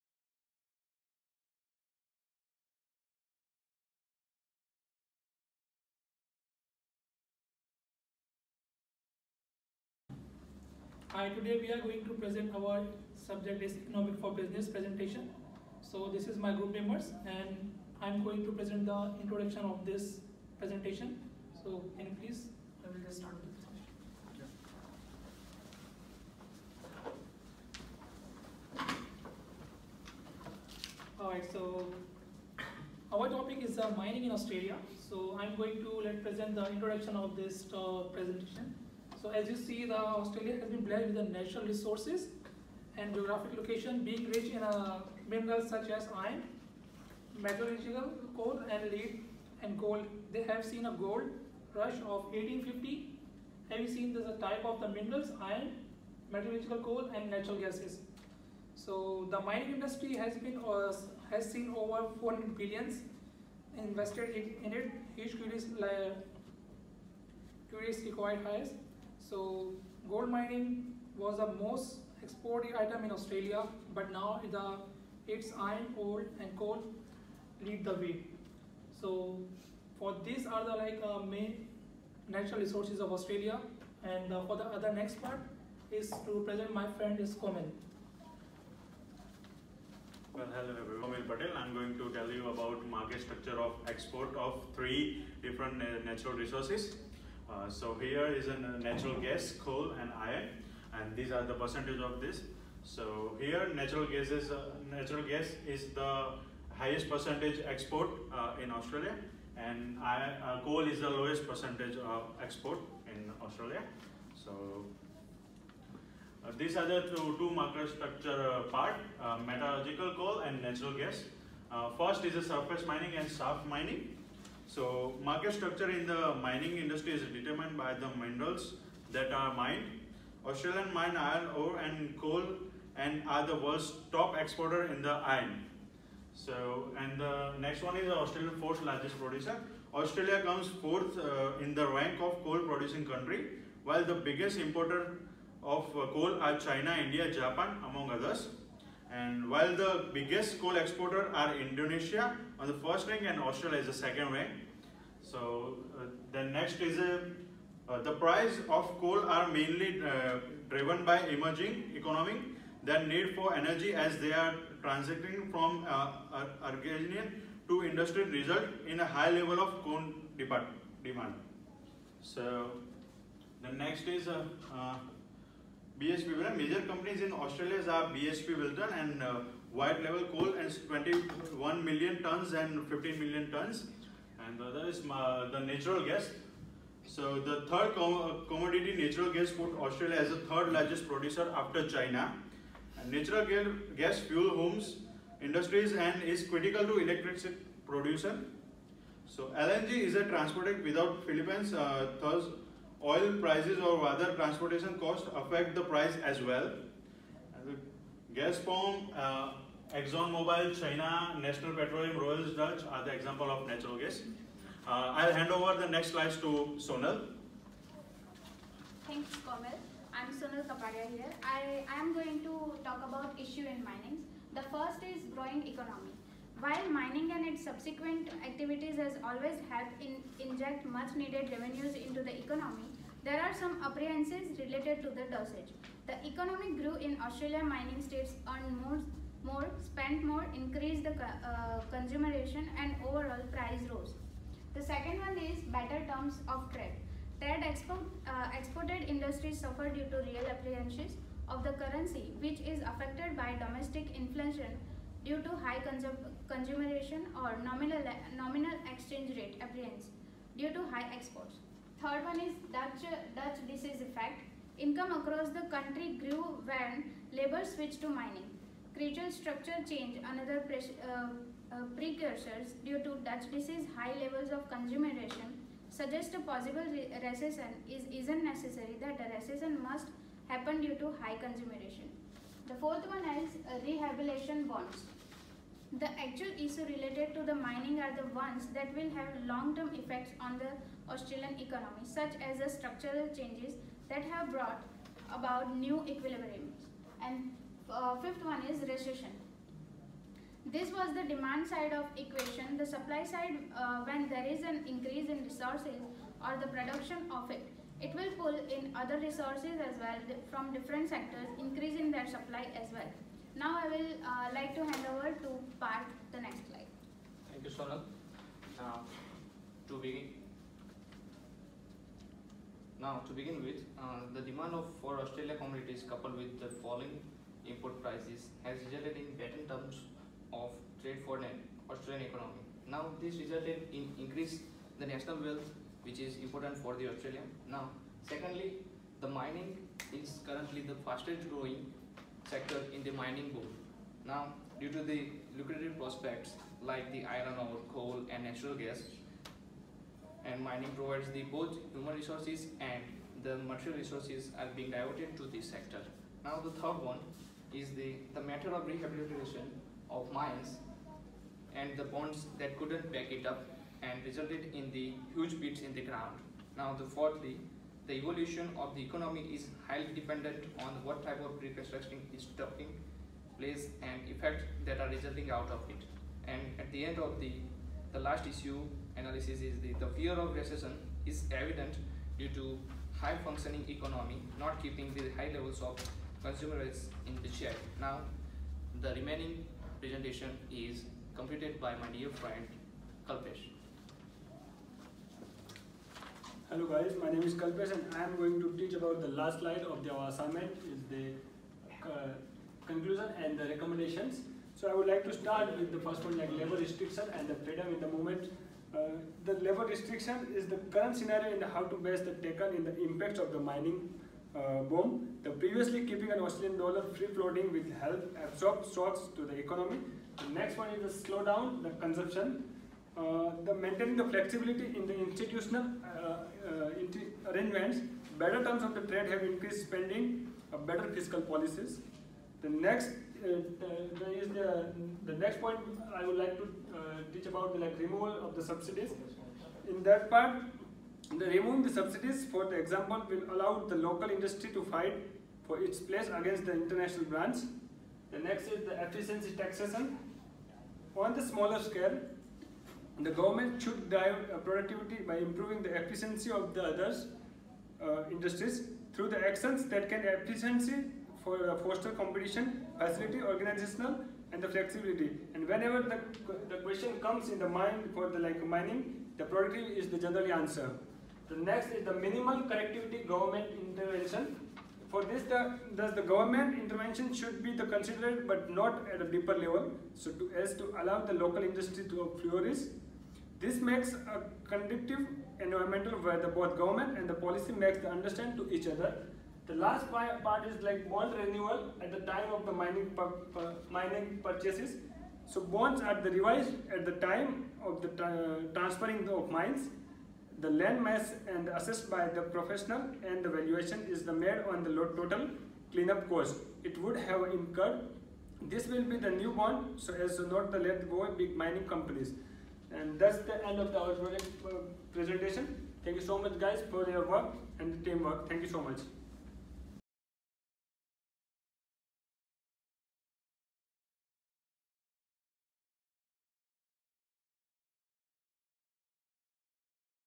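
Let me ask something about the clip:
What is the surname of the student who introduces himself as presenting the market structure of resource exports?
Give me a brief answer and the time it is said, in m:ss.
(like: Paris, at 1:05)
Patel, at 1:31.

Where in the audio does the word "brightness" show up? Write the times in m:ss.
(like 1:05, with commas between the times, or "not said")
not said.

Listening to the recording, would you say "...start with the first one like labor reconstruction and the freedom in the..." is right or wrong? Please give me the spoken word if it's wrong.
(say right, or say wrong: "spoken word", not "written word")
wrong: "restriction", not "reconstruction".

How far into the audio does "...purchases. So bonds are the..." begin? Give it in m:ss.
8:14.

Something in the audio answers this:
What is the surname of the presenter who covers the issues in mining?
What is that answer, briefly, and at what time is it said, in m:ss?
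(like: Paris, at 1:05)
Kapadiya, at 3:40.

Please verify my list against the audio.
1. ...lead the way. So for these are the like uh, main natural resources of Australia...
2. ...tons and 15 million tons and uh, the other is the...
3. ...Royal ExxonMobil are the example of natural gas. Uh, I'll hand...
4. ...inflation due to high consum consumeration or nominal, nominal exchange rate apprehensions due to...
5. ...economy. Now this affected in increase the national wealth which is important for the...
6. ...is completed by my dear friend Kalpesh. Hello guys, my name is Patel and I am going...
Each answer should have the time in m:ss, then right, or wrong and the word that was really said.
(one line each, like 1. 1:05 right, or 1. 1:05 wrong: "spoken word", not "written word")
1. 1:17 right
2. 3:02 right
3. 3:32 wrong: "Dutch", not "ExxonMobil"
4. 4:14 right
5. 5:32 wrong: "resulted", not "affected"
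6. 6:30 wrong: "Kalpesh", not "Patel".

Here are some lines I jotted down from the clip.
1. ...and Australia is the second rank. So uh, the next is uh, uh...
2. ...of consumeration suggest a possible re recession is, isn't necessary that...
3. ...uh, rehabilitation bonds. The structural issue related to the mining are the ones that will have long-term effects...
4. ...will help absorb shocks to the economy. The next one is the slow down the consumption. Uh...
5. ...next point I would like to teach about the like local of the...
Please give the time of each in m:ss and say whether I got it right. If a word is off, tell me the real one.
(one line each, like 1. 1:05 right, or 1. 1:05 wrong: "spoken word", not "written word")
1. 2:33 right
2. 4:34 right
3. 4:43 wrong: "actual", not "structural"
4. 6:57 right
5. 7:15 wrong: "removal", not "local".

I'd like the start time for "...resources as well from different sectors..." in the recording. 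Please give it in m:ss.
5:09.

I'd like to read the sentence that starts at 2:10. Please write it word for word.
Australian mine iron ore and coal and are the world's top exporter in the iron.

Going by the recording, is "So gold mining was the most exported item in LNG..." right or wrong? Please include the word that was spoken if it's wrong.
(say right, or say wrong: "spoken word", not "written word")
wrong: "Australia", not "LNG".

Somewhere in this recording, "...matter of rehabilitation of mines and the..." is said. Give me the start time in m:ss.
5:58.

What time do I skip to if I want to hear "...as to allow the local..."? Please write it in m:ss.
8:00.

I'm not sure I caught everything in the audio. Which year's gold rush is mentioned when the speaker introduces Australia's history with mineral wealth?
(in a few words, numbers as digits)
1850.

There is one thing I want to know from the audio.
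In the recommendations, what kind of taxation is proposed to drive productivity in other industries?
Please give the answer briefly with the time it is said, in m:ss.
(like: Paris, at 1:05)
Efficiency taxation, at 7:29.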